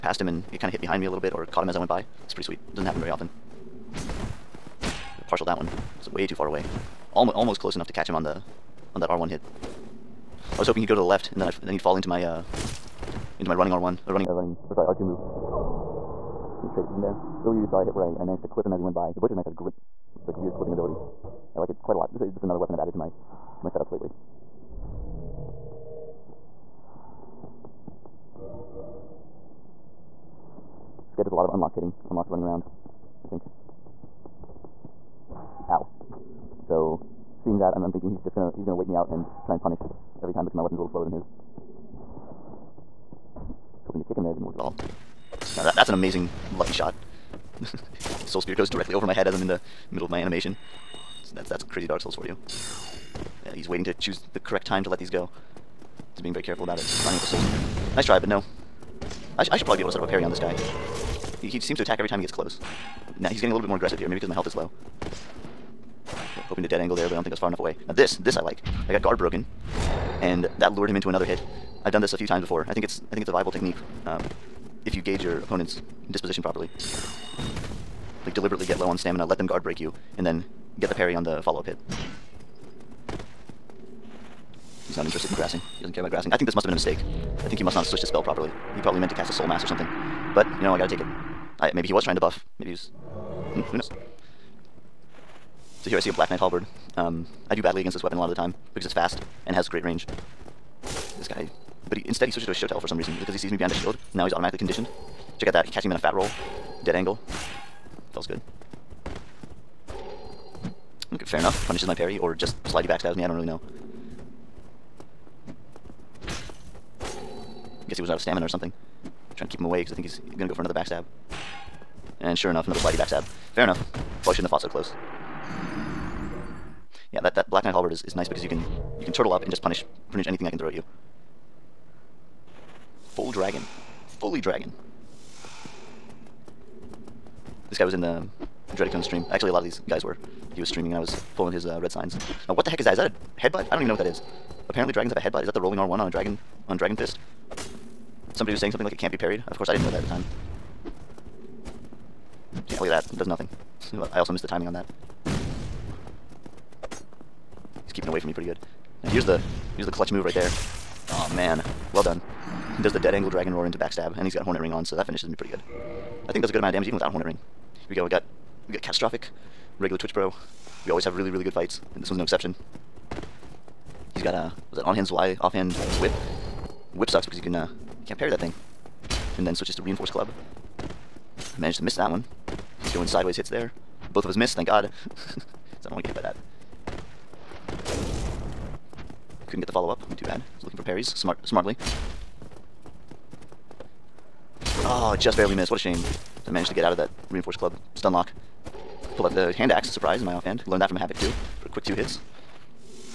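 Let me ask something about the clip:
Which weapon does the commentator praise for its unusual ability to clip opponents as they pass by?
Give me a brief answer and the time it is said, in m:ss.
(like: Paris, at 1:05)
butcher's knife, at 0:19.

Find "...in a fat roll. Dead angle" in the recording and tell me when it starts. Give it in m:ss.
1:45.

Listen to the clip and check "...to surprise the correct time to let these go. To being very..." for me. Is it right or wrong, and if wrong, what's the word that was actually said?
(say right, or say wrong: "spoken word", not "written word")
wrong: "choose", not "surprise".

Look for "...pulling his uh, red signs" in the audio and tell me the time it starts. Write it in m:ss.
2:21.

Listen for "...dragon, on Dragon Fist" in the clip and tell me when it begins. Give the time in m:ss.
2:26.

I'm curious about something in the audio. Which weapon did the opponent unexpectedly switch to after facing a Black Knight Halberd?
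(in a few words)
Shotel.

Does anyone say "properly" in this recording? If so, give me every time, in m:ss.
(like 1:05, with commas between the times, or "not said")
1:16, 1:28.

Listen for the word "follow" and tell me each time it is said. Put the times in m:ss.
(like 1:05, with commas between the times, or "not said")
1:21, 3:09.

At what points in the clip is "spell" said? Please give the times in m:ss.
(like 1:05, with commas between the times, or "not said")
1:28.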